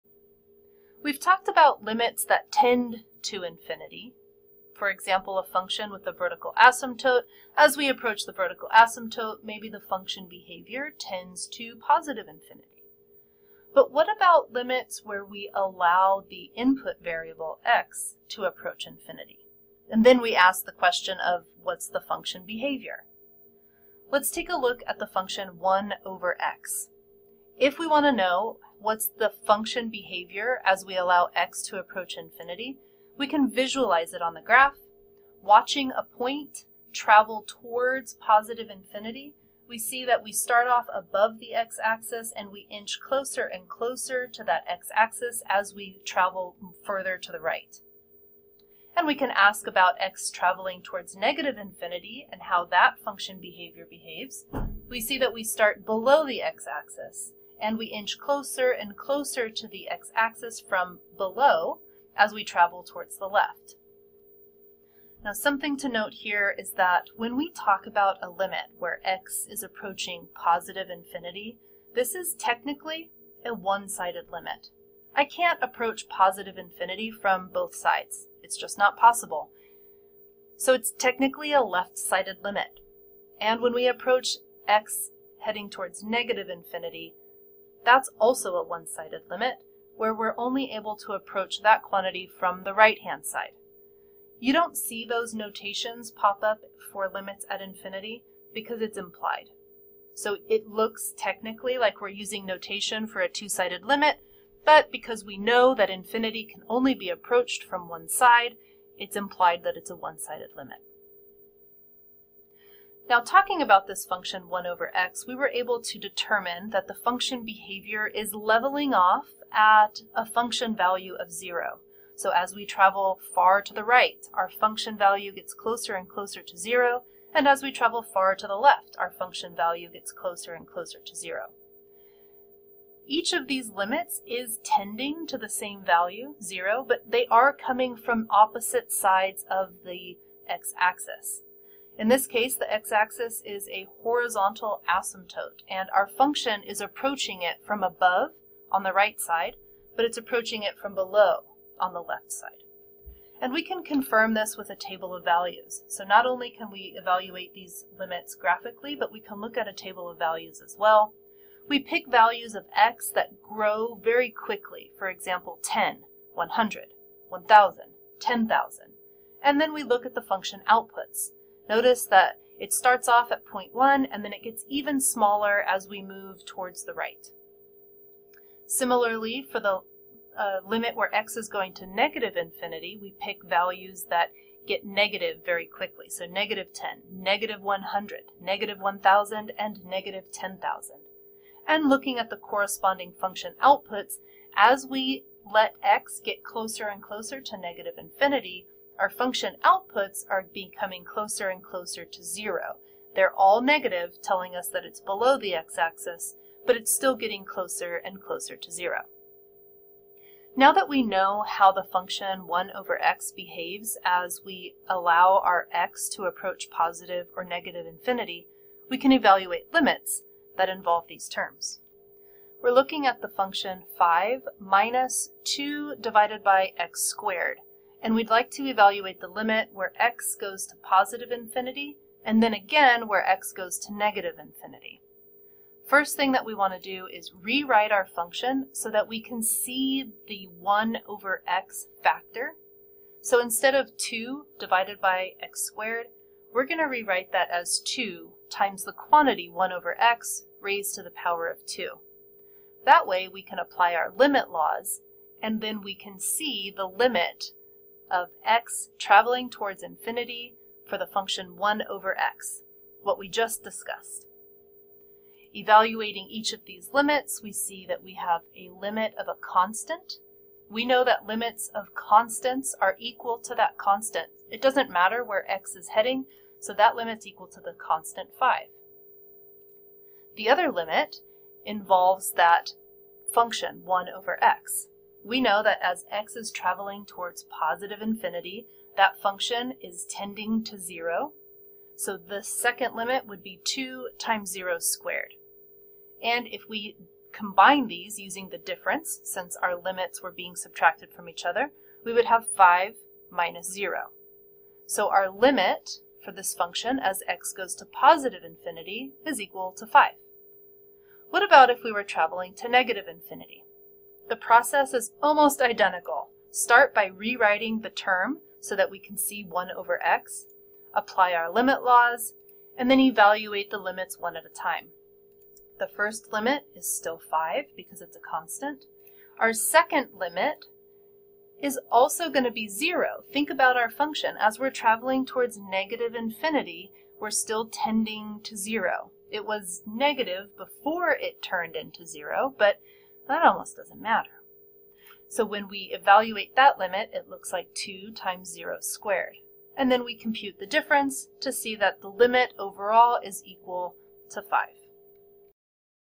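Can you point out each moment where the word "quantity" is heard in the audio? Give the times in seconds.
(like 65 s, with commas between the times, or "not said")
91 s, 248 s.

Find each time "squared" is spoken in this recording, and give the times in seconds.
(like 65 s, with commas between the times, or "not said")
227 s, 245 s, 294 s, 348 s.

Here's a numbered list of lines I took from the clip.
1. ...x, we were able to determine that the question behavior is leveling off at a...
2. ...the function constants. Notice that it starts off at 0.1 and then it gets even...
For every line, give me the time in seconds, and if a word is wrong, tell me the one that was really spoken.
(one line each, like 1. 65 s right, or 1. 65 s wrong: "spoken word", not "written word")
1. 114 s wrong: "function", not "question"
2. 170 s wrong: "outputs", not "constants".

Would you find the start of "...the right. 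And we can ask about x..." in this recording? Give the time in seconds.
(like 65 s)
47 s.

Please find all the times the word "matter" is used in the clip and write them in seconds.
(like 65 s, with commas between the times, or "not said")
274 s, 344 s.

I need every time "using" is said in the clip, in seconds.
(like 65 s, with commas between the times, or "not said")
102 s, 298 s.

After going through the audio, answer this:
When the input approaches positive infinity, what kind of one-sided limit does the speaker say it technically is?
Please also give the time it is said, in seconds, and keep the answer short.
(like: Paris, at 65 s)
Left-sided limit, at 81 s.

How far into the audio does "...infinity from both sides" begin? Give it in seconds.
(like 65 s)
76 s.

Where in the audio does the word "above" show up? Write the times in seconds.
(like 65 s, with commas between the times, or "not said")
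40 s, 147 s.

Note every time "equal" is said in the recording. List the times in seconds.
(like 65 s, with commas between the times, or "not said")
272 s, 277 s, 309 s, 353 s.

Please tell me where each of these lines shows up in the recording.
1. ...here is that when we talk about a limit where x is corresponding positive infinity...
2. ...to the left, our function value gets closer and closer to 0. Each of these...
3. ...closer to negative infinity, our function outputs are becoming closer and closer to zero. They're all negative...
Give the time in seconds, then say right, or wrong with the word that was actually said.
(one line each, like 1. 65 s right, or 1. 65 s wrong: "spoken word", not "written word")
1. 66 s wrong: "approaching", not "corresponding"
2. 128 s right
3. 197 s right.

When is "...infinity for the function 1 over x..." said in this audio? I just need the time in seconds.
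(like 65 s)
259 s.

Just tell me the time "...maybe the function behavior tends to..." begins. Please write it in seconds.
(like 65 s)
9 s.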